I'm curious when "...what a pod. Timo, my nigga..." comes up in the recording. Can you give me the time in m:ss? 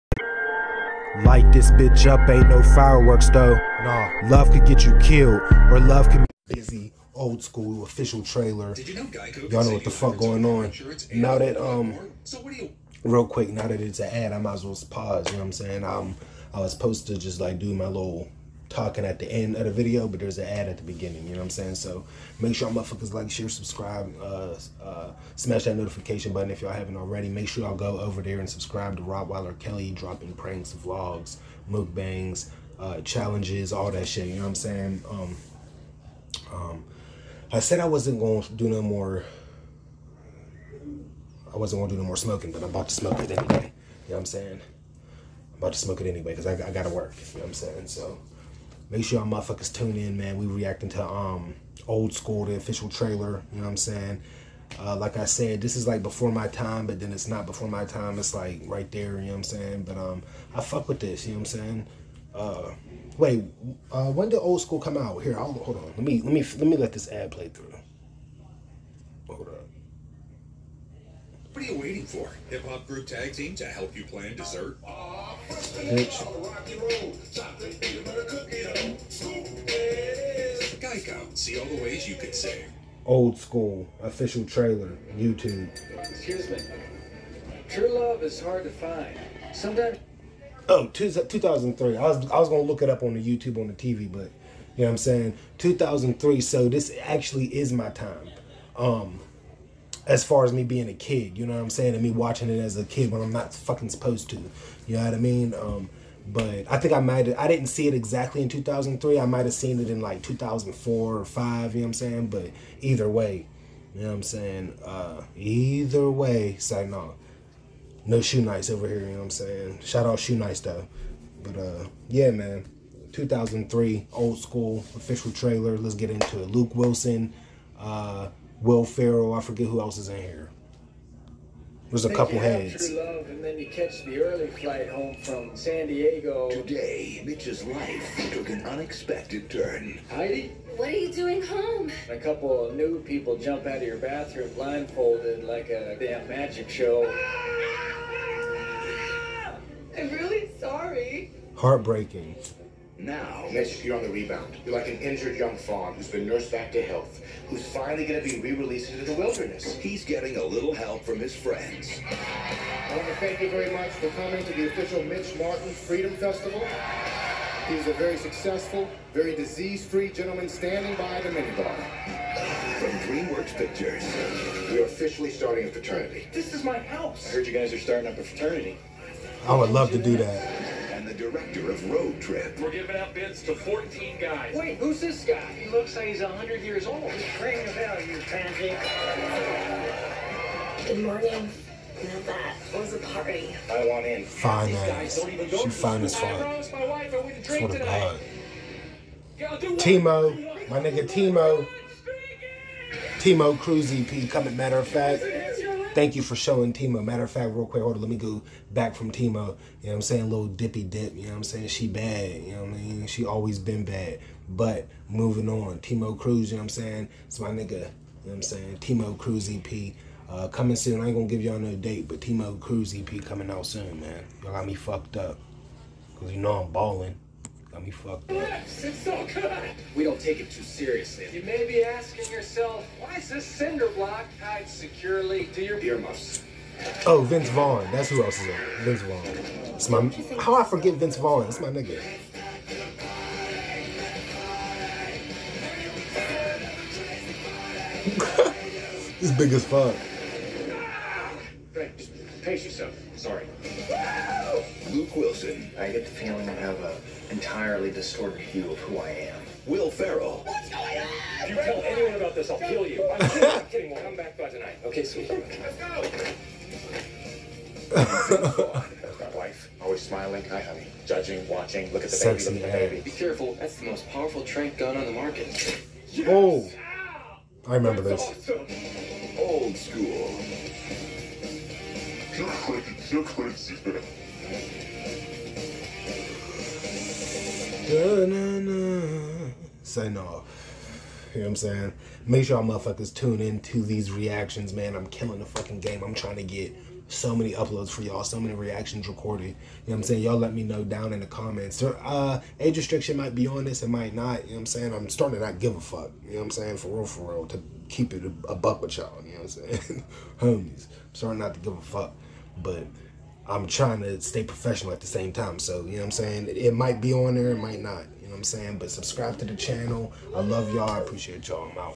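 3:17.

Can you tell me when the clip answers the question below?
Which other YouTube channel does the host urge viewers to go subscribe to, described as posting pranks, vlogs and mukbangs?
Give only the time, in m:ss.
0:29.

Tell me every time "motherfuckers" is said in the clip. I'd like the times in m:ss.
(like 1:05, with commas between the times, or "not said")
0:22, 0:49, 4:52.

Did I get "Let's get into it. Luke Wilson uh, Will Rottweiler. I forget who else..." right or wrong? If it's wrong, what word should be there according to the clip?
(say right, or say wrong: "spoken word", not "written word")
wrong: "Ferrell", not "Rottweiler".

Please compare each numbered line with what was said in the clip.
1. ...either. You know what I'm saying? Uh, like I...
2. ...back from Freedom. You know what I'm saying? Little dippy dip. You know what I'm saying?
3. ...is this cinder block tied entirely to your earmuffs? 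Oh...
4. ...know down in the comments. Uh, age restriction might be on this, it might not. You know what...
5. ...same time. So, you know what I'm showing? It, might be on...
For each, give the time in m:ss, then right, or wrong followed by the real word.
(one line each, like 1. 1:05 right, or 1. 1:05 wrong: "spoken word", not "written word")
1. 0:52 wrong: "trailer", not "either"
2. 3:28 wrong: "Tima", not "Freedom"
3. 3:53 wrong: "securely", not "entirely"
4. 5:00 right
5. 5:15 wrong: "saying", not "showing".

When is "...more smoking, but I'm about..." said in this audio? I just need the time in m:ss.
0:42.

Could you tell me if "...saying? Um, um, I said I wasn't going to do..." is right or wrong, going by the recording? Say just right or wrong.
right.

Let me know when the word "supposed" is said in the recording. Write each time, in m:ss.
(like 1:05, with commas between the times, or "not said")
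0:16, 1:43.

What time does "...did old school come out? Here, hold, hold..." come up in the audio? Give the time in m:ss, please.
1:04.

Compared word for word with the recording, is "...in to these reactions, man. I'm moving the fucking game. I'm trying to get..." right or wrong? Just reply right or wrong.
wrong.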